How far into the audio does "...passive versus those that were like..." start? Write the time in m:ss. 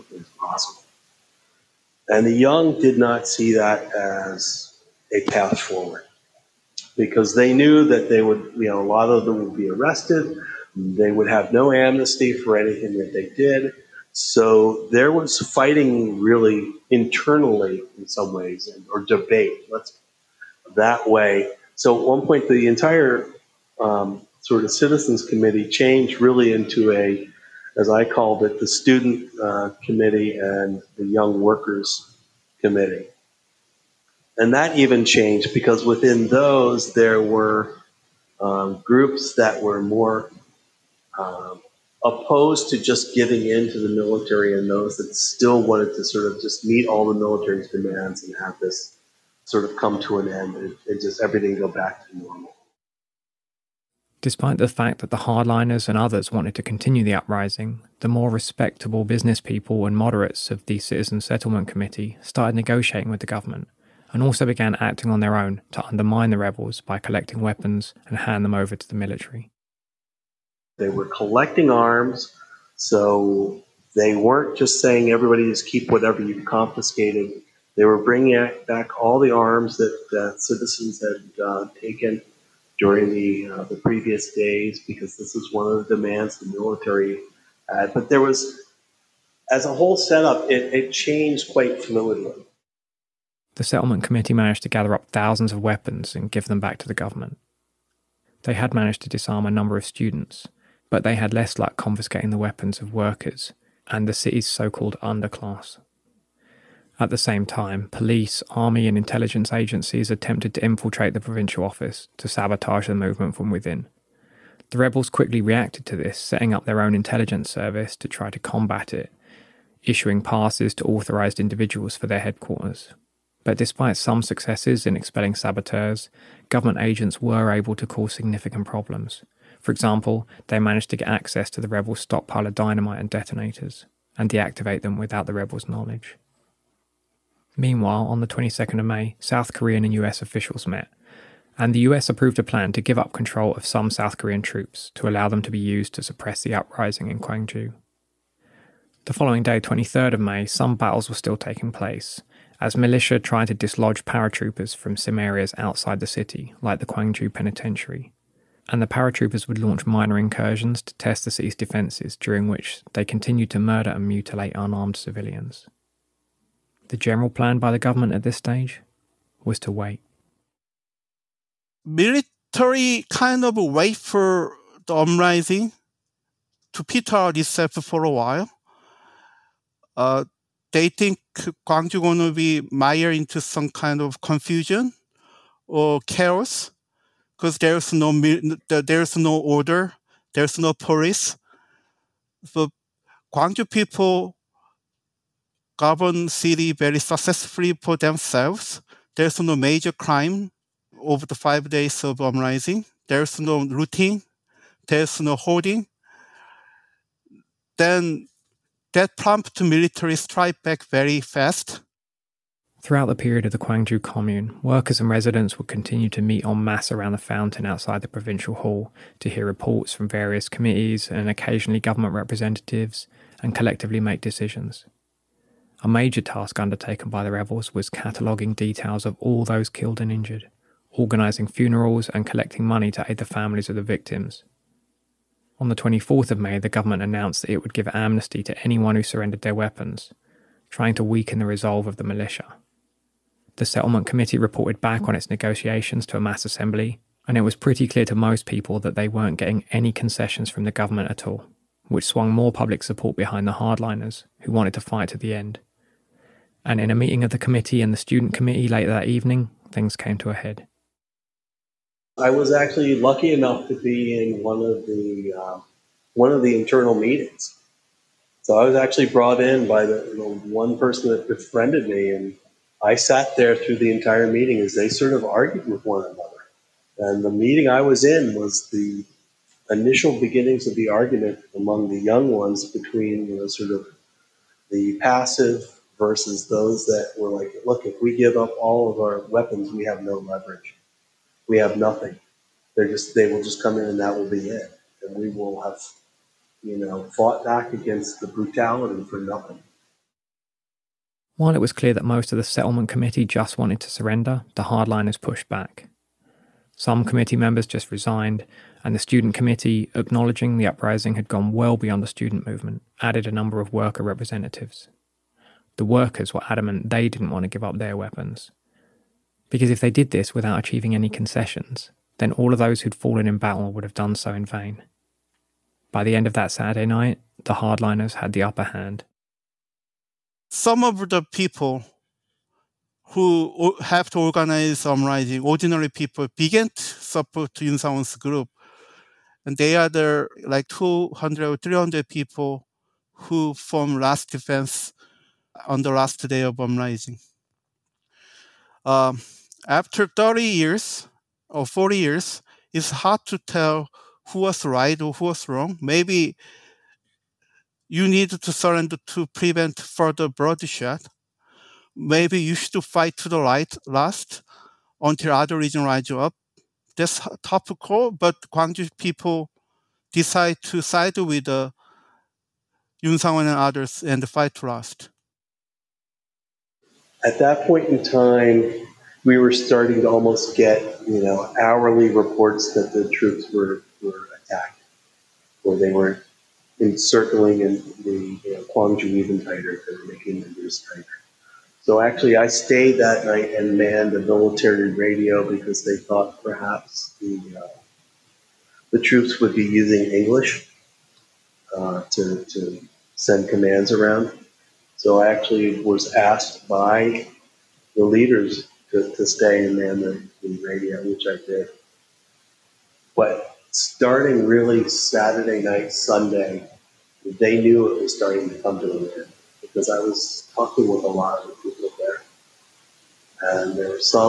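4:45.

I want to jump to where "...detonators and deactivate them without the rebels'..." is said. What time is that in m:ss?
2:13.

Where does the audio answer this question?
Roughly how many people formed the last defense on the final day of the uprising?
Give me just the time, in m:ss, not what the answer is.
5:40.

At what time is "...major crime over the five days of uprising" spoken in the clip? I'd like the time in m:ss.
3:19.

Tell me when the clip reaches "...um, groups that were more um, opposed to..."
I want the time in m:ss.
0:38.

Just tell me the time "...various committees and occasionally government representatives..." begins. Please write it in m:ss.
3:40.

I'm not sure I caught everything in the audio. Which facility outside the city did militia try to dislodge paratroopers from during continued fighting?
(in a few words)
Gwangju Penitentiary.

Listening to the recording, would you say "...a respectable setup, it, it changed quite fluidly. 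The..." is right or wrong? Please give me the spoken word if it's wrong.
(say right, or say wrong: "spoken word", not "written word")
wrong: "whole", not "respectable".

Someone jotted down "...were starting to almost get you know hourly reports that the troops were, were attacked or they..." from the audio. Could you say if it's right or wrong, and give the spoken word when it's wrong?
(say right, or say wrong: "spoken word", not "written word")
right.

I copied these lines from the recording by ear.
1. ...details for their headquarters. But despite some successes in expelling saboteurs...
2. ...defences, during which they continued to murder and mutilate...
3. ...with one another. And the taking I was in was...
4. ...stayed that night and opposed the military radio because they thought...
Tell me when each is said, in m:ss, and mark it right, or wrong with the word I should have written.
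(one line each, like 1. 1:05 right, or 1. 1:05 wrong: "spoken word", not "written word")
1. 2:01 wrong: "individuals", not "details"
2. 2:41 right
3. 4:35 wrong: "meeting", not "taking"
4. 6:32 wrong: "manned", not "opposed".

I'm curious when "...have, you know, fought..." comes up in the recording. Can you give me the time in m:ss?
4:55.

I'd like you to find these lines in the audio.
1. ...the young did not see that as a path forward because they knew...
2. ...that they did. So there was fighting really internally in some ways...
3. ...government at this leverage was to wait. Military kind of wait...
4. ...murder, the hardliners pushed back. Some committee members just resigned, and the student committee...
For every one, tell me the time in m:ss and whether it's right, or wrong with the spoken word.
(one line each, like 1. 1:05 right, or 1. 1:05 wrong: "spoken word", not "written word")
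1. 0:02 right
2. 0:12 right
3. 2:47 wrong: "stage", not "leverage"
4. 5:03 wrong: "surrender", not "murder".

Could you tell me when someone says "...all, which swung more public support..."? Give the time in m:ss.
4:11.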